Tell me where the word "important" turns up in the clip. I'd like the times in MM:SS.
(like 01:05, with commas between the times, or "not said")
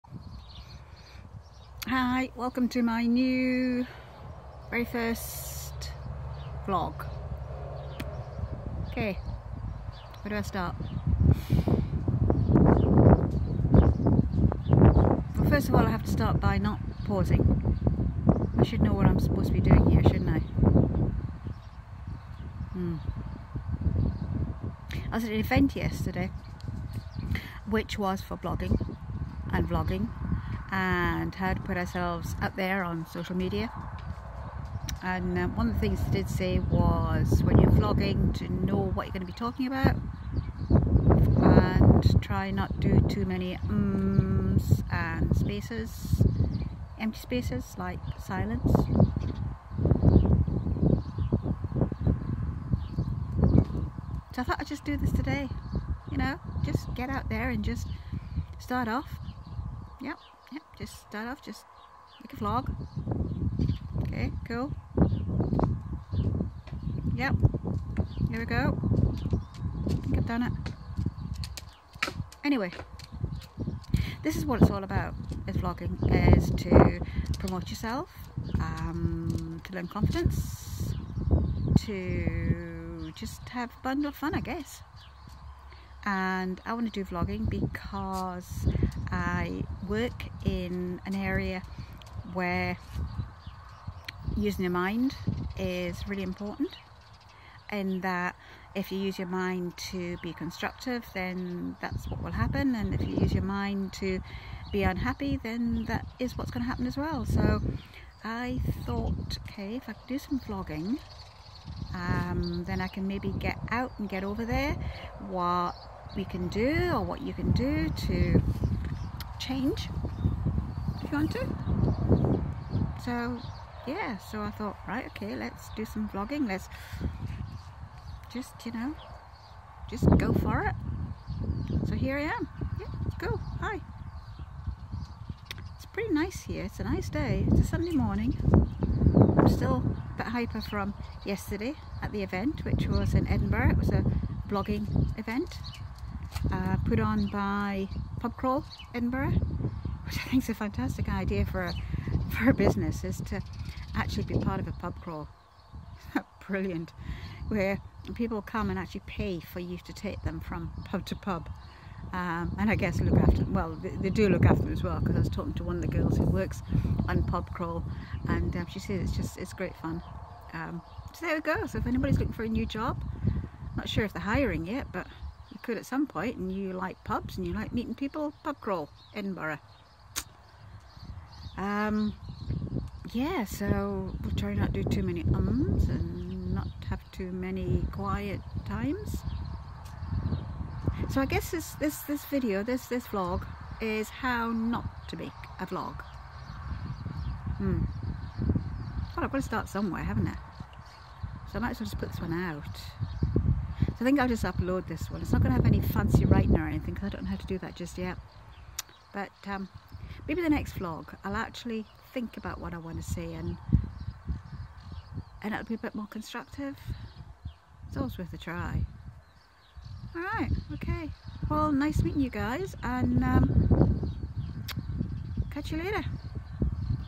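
01:36.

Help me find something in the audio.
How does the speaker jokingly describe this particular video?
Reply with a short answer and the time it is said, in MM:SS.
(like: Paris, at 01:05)
how not to make a vlog, at 03:14.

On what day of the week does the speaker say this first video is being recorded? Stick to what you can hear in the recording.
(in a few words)
Sunday.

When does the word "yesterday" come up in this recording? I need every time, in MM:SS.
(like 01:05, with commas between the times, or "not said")
00:25, 02:21.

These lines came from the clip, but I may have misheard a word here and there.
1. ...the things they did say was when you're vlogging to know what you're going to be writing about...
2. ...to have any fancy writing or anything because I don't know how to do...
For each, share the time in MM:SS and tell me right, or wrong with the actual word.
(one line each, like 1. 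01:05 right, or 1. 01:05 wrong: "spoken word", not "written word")
1. 00:35 wrong: "talking", not "writing"
2. 03:25 right.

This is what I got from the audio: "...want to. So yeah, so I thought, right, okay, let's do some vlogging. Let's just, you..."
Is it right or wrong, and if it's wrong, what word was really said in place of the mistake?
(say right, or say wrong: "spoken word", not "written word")
right.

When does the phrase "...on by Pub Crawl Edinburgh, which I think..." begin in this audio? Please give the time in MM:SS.
02:26.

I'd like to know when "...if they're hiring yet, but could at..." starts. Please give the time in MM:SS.
02:54.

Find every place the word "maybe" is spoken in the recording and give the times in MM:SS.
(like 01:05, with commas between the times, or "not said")
01:53, 03:30.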